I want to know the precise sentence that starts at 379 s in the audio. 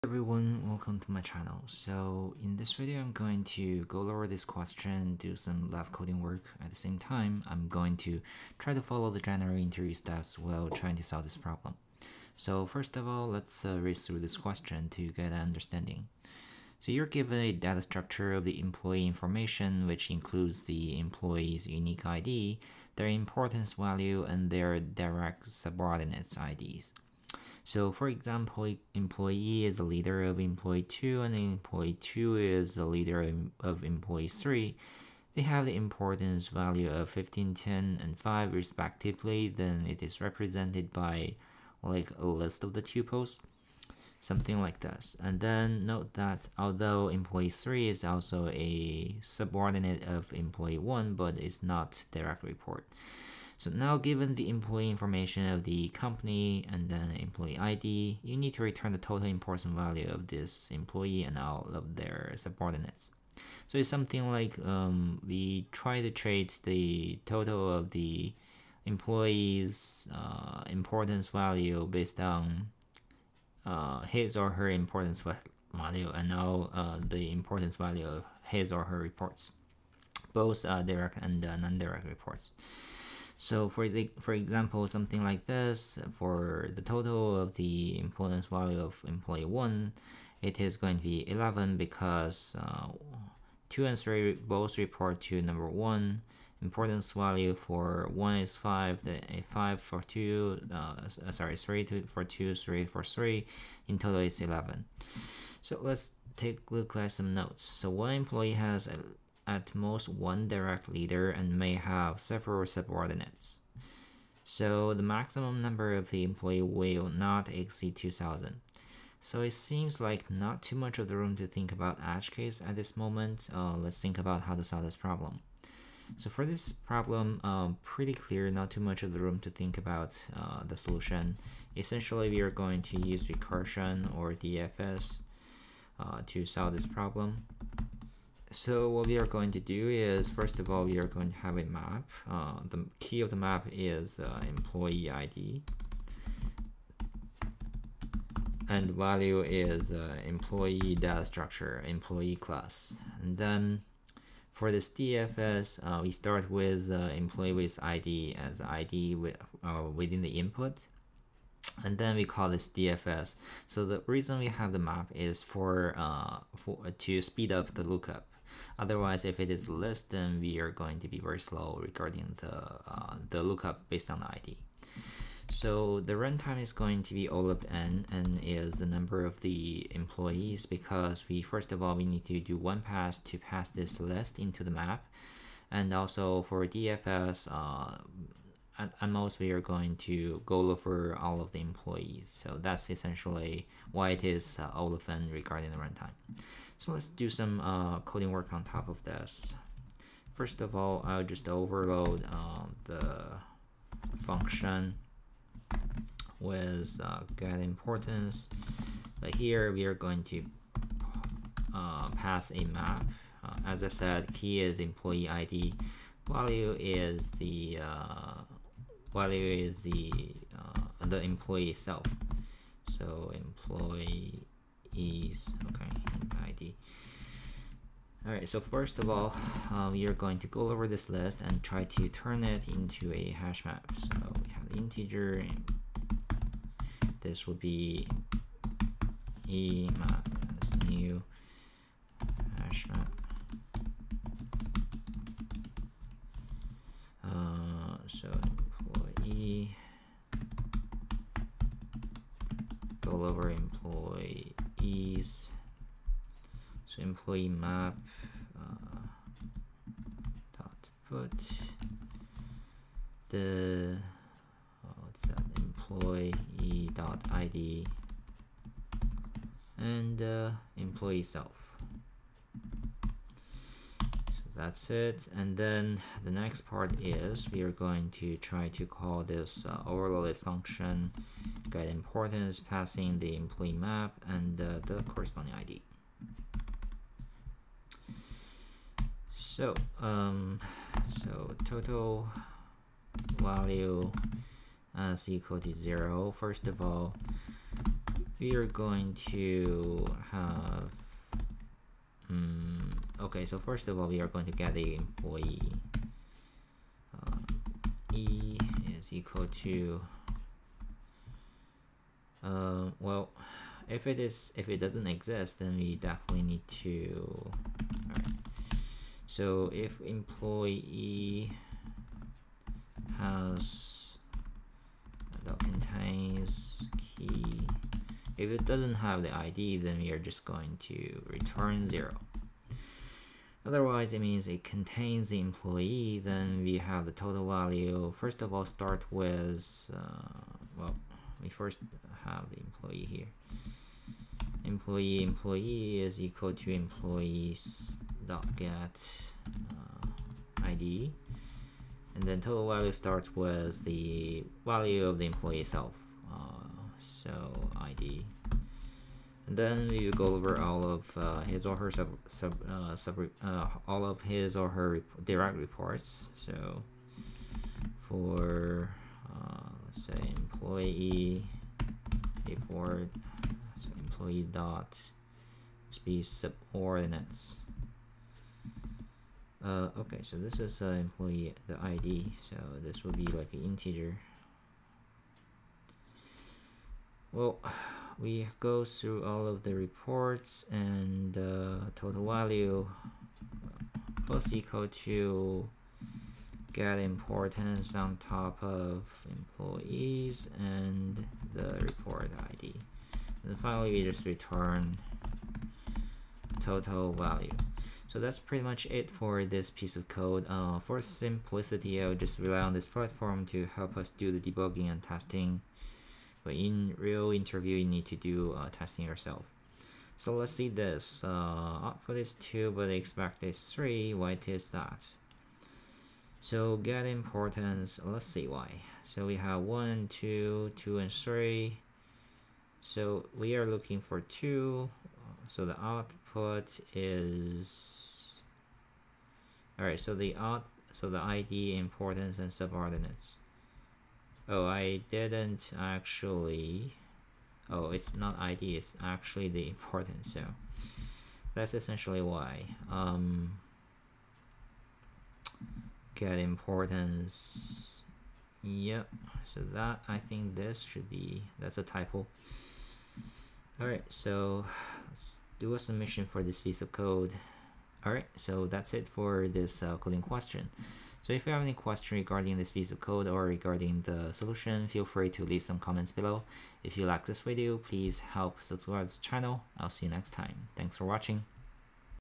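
Uh, okay, so this is uh, employee the ID, so this will be like an integer.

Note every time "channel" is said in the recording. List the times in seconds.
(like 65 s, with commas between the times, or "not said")
1 s, 479 s.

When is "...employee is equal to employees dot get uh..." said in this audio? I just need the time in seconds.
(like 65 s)
345 s.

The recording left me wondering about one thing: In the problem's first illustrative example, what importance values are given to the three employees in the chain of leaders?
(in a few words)
15, 10, and 5.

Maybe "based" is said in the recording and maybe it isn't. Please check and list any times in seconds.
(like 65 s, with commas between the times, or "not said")
71 s, 173 s.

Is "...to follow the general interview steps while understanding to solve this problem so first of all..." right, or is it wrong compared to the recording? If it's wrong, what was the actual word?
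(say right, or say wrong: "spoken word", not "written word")
wrong: "trying", not "understanding".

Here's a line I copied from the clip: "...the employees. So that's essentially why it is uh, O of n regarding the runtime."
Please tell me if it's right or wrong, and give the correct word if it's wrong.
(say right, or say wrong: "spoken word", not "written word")
right.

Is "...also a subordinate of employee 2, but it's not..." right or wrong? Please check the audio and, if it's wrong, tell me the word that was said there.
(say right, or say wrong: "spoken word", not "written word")
wrong: "1", not "2".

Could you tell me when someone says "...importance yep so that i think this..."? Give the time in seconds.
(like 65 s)
456 s.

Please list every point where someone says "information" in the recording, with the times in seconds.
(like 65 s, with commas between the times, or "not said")
19 s, 54 s.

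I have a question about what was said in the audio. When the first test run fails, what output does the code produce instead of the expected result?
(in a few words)
2.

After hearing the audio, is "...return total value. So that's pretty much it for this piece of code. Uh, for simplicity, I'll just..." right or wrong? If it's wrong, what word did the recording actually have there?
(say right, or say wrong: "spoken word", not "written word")
right.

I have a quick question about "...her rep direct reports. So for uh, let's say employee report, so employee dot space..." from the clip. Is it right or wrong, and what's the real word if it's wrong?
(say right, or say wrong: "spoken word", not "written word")
right.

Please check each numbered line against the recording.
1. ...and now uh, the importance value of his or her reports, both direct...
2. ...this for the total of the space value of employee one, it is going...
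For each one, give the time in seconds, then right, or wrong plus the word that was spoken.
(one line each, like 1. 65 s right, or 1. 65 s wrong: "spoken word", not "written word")
1. 76 s right
2. 85 s wrong: "importance", not "space".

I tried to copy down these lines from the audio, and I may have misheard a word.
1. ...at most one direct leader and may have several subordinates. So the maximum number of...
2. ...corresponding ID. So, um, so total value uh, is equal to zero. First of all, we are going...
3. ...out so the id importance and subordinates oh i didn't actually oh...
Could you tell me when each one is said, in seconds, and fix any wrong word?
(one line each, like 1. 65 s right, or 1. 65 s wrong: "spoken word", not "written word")
1. 109 s right
2. 285 s right
3. 440 s right.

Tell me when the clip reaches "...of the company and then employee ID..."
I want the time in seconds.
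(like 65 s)
55 s.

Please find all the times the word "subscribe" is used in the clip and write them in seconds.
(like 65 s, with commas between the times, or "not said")
478 s.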